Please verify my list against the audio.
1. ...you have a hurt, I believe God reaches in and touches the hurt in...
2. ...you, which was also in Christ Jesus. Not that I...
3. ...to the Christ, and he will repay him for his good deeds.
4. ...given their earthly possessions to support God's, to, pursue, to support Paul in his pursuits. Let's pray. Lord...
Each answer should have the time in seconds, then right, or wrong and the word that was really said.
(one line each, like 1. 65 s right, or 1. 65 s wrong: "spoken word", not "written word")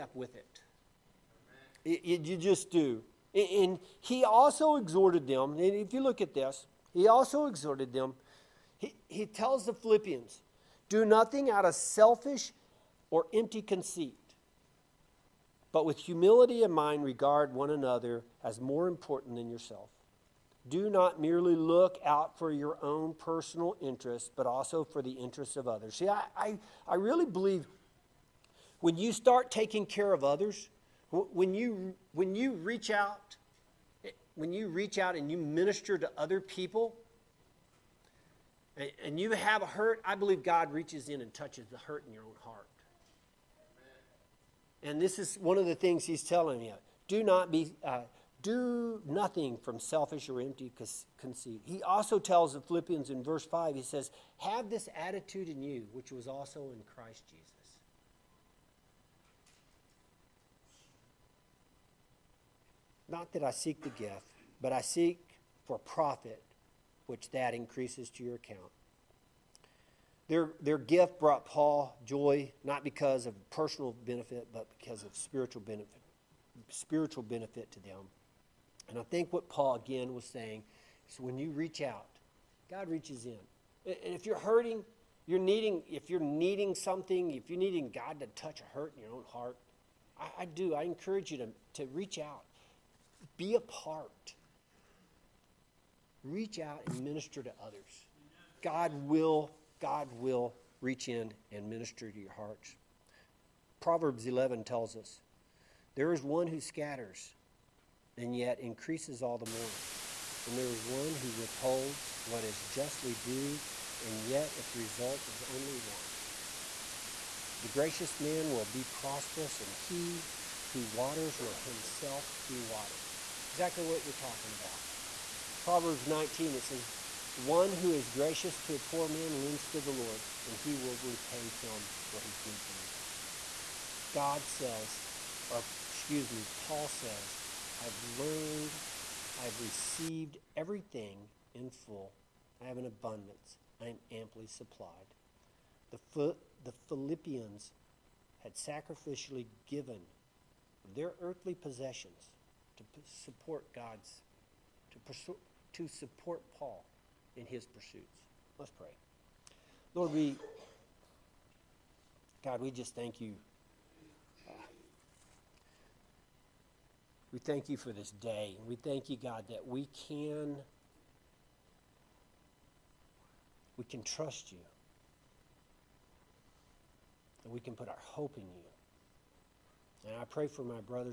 1. 39 s right
2. 55 s right
3. 129 s wrong: "Lord", not "Christ"
4. 149 s right.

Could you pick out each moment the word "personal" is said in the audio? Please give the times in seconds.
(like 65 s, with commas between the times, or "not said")
23 s, 73 s.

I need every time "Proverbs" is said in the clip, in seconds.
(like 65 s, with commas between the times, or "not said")
103 s, 125 s.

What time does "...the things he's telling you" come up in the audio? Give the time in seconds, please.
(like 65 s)
45 s.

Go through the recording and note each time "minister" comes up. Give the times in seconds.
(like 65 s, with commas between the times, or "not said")
35 s, 97 s, 101 s.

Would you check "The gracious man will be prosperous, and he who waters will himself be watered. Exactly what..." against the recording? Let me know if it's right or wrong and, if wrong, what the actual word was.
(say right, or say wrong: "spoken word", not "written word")
right.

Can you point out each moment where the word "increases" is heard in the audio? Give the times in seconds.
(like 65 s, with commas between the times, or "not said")
67 s, 108 s.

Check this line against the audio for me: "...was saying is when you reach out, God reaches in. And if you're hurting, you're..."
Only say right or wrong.
right.